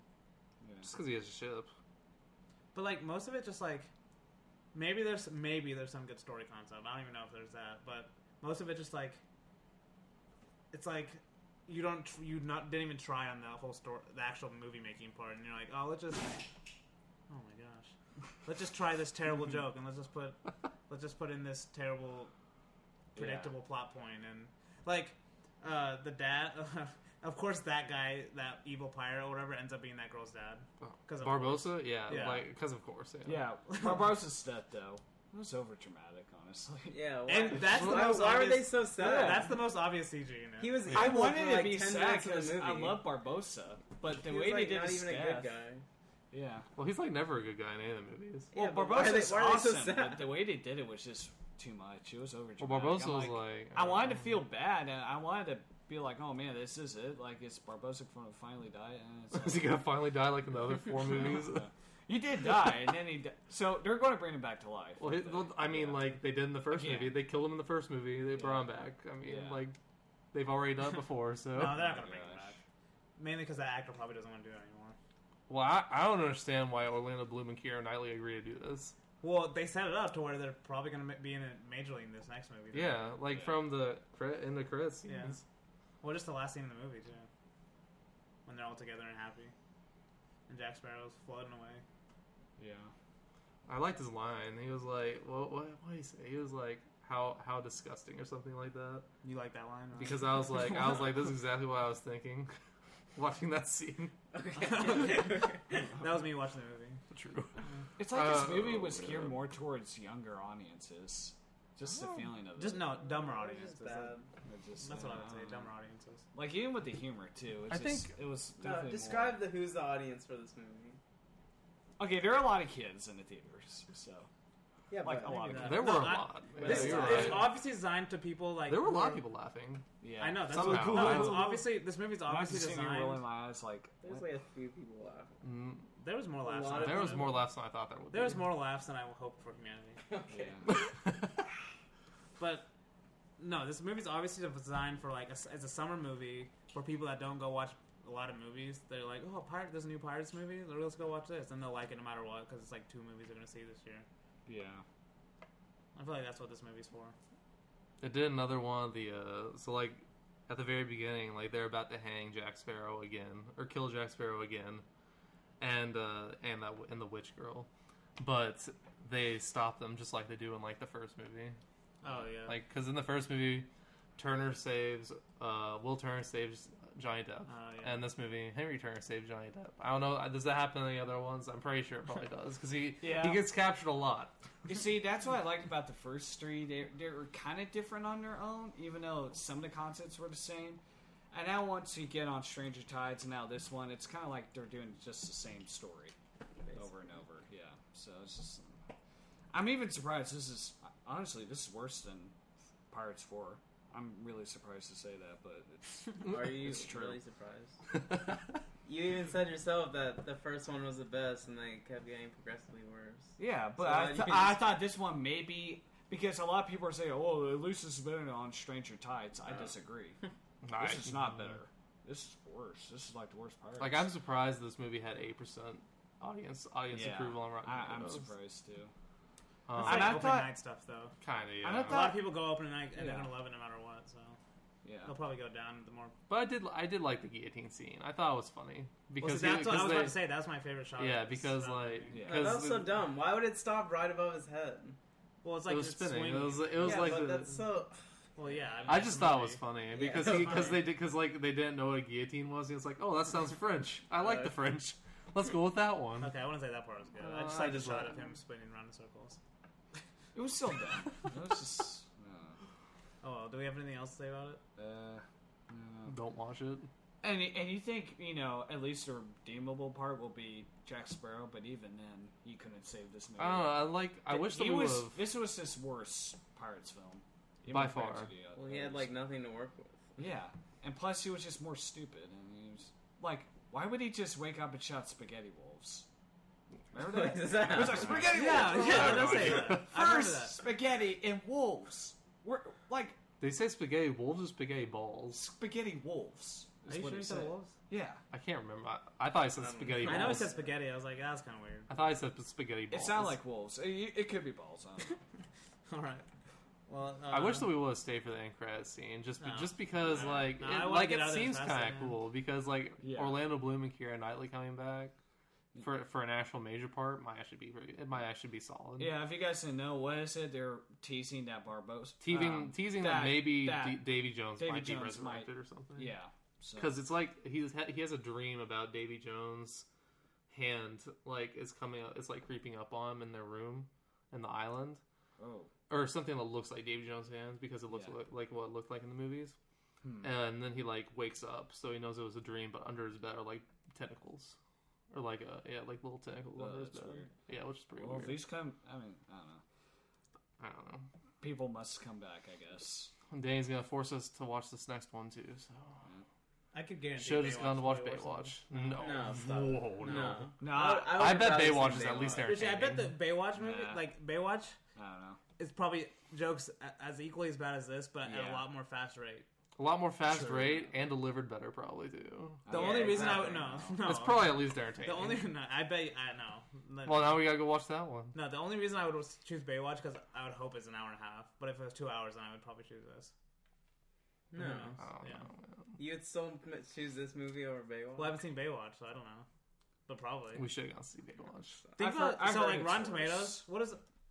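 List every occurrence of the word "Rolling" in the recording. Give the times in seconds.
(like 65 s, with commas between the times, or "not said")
133 s.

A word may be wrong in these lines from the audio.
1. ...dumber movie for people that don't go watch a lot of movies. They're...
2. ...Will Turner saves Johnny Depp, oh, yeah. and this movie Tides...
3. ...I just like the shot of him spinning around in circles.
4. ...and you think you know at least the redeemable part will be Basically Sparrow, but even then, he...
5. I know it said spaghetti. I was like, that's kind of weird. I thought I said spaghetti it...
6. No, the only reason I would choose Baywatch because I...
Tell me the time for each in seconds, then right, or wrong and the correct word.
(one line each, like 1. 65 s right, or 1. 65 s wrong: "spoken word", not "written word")
1. 145 s wrong: "summer", not "dumber"
2. 175 s wrong: "Henry", not "Tides"
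3. 257 s right
4. 267 s wrong: "Jack", not "Basically"
5. 300 s right
6. 378 s right.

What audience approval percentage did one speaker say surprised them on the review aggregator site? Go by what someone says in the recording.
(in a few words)
8 percent.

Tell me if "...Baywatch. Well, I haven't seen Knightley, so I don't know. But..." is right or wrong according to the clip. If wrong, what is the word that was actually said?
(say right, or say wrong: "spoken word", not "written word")
wrong: "Baywatch", not "Knightley".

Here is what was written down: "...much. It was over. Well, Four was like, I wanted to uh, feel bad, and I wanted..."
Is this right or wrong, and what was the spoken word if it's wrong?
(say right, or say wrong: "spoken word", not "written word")
wrong: "Barbossa", not "Four".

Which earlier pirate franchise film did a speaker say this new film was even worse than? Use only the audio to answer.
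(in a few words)
Pirates Four.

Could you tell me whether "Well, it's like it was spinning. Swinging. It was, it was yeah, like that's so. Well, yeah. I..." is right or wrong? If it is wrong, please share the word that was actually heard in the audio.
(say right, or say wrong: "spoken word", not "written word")
right.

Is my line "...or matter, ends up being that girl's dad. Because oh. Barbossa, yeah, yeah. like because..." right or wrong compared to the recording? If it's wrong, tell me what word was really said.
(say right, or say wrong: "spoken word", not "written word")
wrong: "whatever", not "matter".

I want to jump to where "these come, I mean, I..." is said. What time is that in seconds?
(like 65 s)
348 s.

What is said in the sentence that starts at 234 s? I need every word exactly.
So yeah, they'll probably go down the more.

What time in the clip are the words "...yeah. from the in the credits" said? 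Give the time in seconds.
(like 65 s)
83 s.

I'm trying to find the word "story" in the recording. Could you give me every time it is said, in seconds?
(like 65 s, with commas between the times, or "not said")
6 s, 13 s, 195 s.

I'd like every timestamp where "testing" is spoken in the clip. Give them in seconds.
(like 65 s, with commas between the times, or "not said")
not said.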